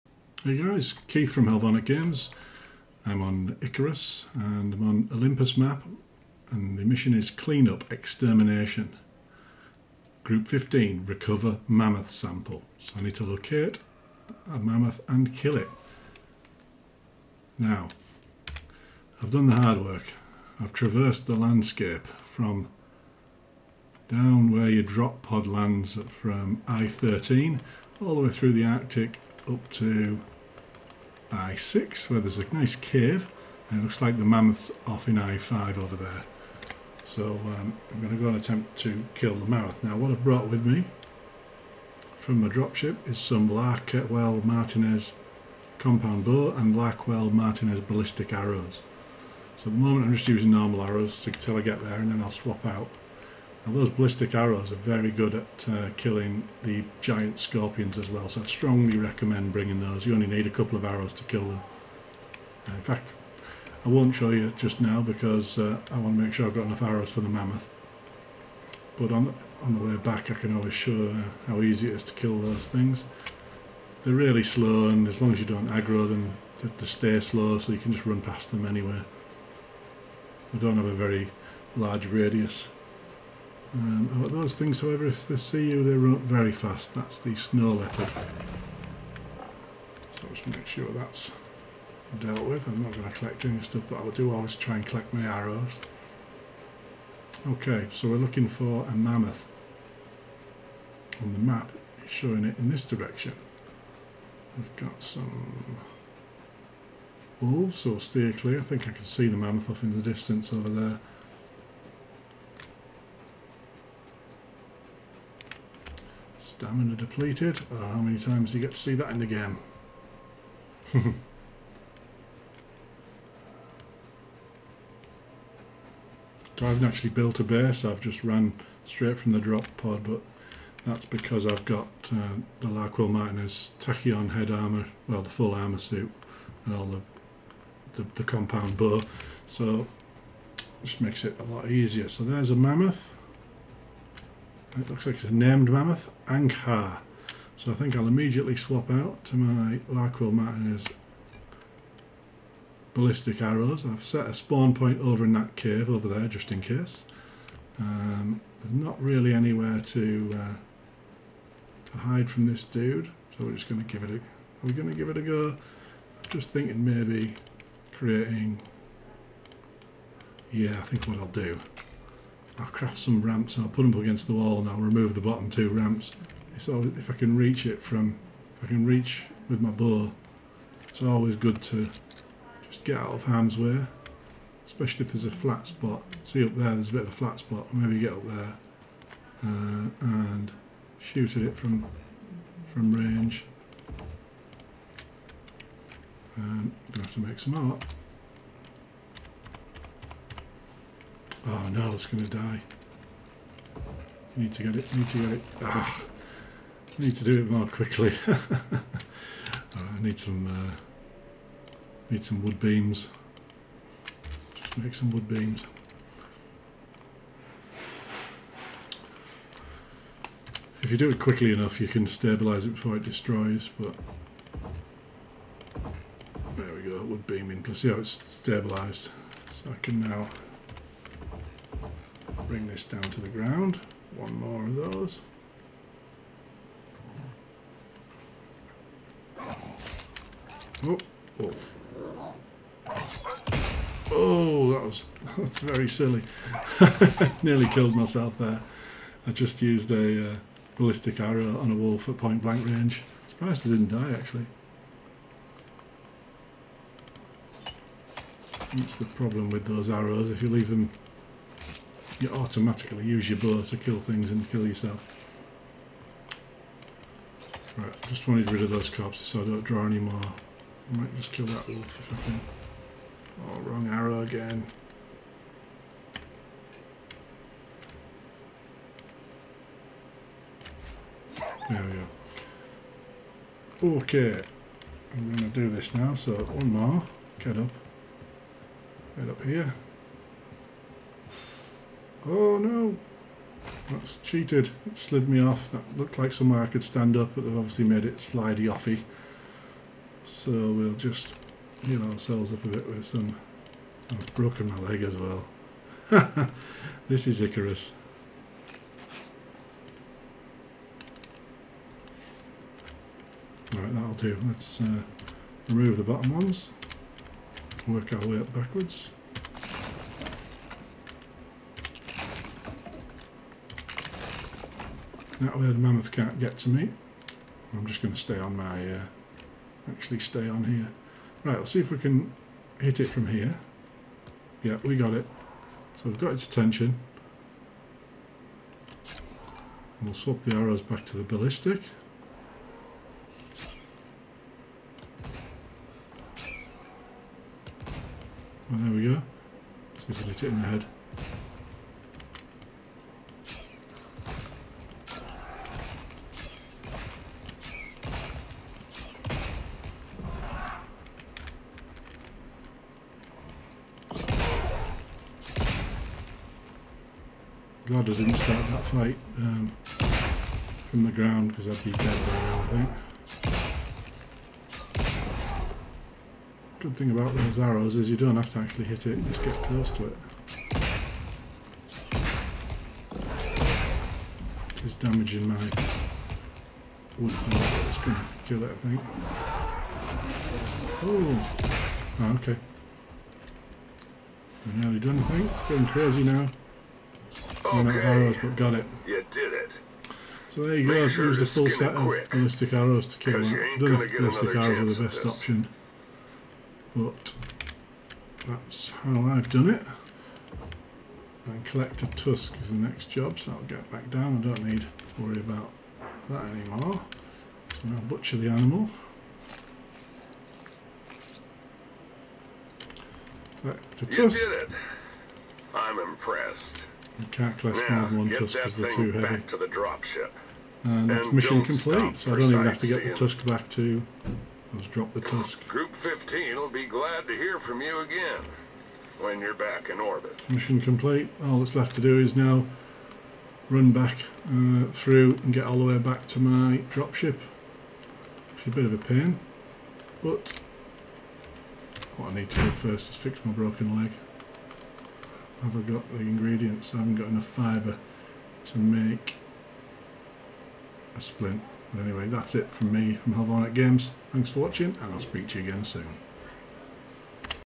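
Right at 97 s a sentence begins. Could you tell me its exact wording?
Okay, so we're looking for a mammoth.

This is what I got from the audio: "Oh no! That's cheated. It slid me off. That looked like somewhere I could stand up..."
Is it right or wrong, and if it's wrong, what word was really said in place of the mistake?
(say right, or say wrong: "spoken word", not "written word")
right.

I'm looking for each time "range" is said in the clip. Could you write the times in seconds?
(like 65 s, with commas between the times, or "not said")
192 s, 252 s.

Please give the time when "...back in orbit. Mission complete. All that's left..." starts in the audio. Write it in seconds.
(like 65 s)
439 s.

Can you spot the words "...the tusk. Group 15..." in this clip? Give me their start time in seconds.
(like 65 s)
435 s.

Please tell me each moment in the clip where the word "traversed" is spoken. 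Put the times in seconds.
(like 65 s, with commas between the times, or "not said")
20 s.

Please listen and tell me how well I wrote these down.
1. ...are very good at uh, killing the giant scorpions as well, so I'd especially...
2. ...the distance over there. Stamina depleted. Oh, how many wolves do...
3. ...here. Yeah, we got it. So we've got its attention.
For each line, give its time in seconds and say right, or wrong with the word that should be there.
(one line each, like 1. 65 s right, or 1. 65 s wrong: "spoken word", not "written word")
1. 54 s wrong: "strongly", not "especially"
2. 109 s wrong: "times", not "wolves"
3. 333 s right.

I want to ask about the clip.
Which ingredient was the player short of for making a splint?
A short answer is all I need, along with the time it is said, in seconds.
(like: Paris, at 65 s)
Fibre, at 457 s.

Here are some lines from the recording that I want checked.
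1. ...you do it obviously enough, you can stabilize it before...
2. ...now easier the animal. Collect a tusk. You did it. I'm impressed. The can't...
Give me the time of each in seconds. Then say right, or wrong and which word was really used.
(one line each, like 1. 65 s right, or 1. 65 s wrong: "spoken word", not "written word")
1. 220 s wrong: "quickly", not "obviously"
2. 417 s wrong: "butcher", not "easier".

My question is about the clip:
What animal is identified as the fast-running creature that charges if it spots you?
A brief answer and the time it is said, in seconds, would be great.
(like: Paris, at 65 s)
Snow leopard, at 87 s.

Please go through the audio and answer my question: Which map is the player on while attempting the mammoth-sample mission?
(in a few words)
Olympus.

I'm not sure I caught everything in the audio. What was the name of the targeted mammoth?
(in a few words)
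Ankar.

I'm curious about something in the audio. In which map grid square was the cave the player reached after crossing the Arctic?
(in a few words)
I6.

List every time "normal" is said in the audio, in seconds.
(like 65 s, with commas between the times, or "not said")
50 s.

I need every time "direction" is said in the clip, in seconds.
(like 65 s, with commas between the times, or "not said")
102 s.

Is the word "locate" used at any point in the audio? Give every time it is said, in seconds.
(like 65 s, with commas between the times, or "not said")
13 s.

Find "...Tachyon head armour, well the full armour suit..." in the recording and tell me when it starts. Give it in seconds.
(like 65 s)
133 s.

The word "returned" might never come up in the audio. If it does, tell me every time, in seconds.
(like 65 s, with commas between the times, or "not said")
not said.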